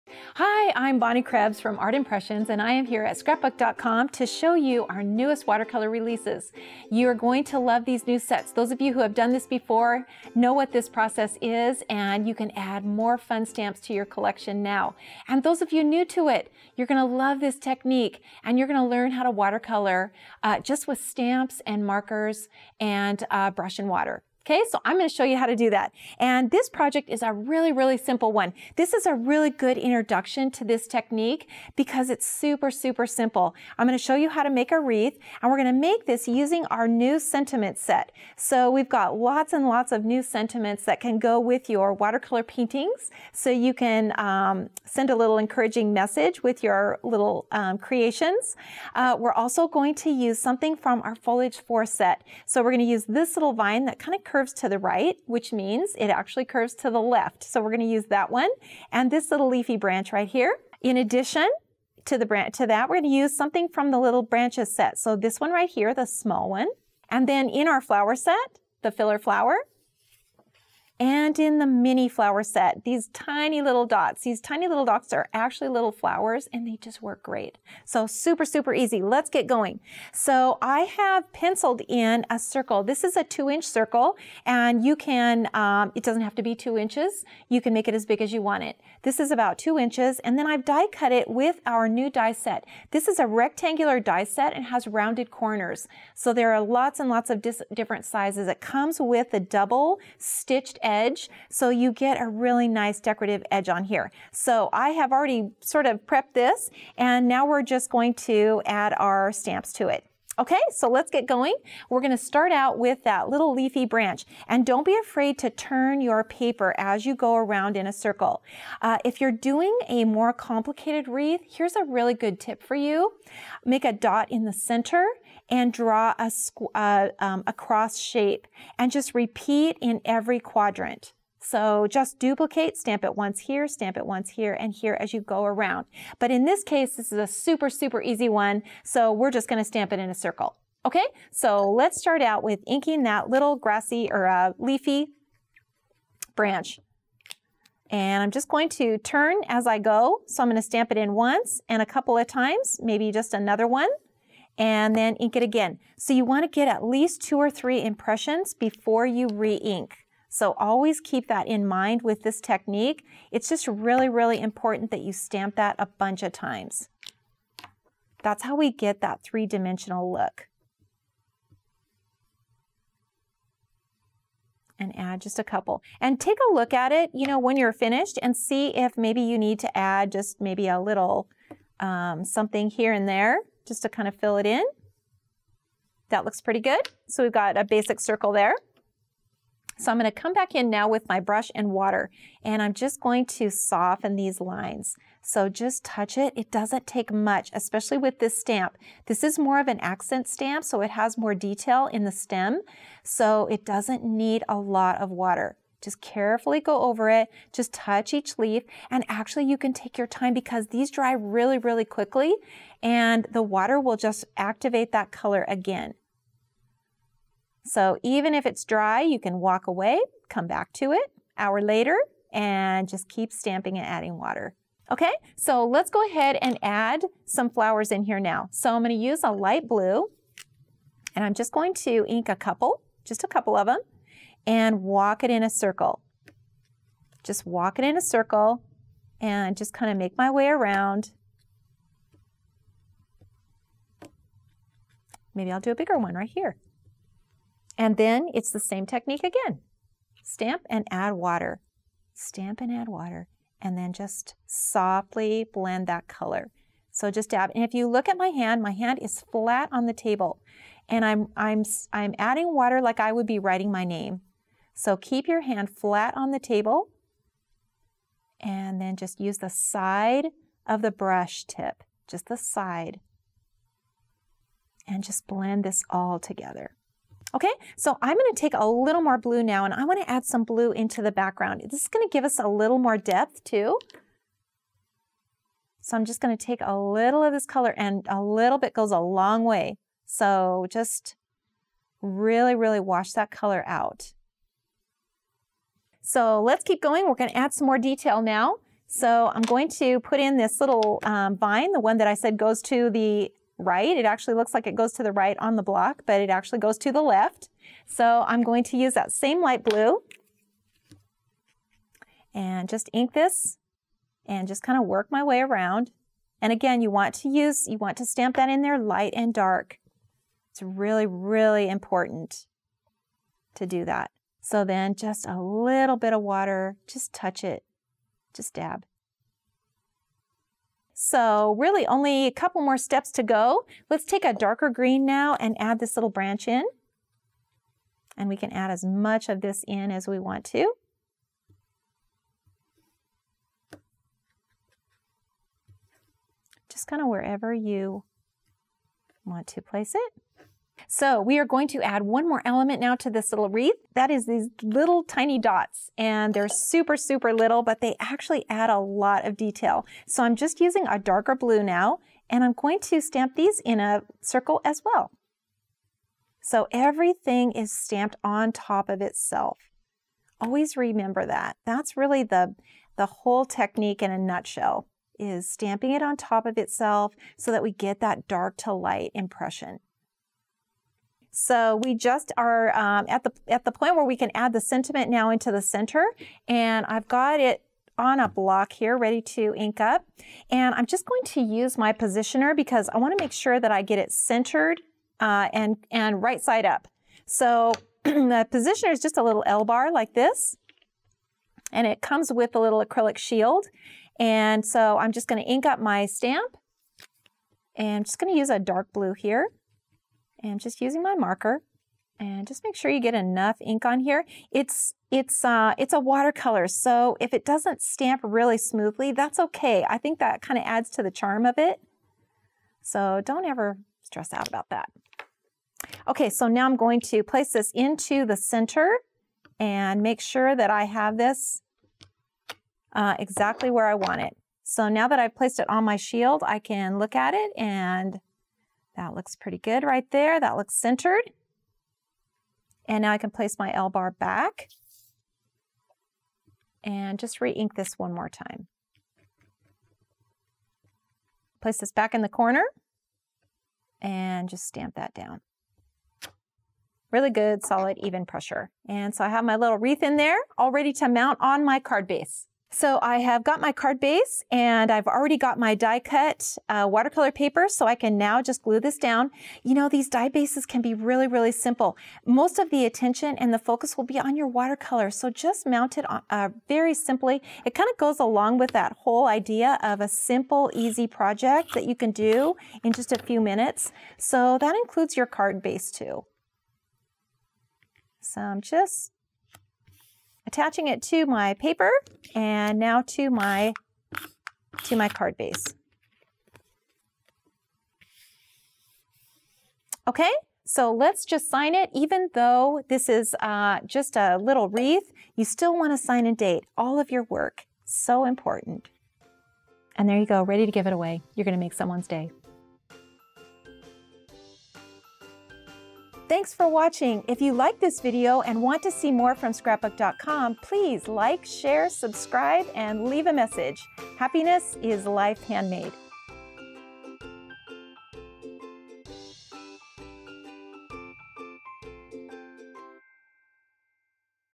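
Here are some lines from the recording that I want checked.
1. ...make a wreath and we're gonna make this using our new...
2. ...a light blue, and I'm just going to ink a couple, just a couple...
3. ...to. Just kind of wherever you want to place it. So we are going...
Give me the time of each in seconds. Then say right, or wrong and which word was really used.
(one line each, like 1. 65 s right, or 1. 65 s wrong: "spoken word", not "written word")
1. 34 s right
2. 229 s right
3. 340 s right.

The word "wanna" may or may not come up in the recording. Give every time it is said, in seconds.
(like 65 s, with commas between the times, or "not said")
279 s, 392 s.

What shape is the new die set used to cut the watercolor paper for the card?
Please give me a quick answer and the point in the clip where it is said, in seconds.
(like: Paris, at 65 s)
rectangular, at 93 s.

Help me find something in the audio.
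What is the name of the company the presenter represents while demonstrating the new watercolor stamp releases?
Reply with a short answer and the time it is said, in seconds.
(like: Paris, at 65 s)
Art Impressions, at 1 s.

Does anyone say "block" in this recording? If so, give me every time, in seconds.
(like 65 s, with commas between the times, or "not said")
305 s, 388 s.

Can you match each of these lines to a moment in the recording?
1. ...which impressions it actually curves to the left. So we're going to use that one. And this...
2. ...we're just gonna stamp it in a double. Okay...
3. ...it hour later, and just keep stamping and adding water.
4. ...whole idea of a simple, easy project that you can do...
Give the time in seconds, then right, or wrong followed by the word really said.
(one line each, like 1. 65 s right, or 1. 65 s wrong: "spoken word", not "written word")
1. 55 s wrong: "means", not "impressions"
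2. 139 s wrong: "circle", not "double"
3. 220 s right
4. 478 s right.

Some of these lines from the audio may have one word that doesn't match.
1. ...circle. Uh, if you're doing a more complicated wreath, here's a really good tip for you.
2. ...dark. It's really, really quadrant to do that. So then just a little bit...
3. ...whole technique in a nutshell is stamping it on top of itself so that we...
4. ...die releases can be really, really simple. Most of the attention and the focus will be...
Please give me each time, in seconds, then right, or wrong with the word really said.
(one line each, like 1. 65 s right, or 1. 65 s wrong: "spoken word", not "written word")
1. 117 s right
2. 319 s wrong: "important", not "quadrant"
3. 373 s right
4. 470 s wrong: "bases", not "releases".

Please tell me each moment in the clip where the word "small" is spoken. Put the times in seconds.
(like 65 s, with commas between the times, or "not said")
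66 s.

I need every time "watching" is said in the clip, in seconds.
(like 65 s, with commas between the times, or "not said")
516 s.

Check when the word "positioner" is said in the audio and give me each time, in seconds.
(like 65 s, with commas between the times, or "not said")
391 s, 398 s.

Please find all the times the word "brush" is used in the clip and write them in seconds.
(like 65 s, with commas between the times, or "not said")
23 s, 191 s, 270 s.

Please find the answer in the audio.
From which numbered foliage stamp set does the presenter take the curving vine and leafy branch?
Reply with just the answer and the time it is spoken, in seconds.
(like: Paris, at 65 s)
foliage four, at 51 s.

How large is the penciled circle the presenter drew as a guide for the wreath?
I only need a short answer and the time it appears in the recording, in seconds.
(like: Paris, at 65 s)
2 inches, at 83 s.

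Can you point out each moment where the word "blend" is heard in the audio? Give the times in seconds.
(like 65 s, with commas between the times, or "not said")
255 s, 275 s.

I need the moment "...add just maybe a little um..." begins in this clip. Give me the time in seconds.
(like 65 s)
179 s.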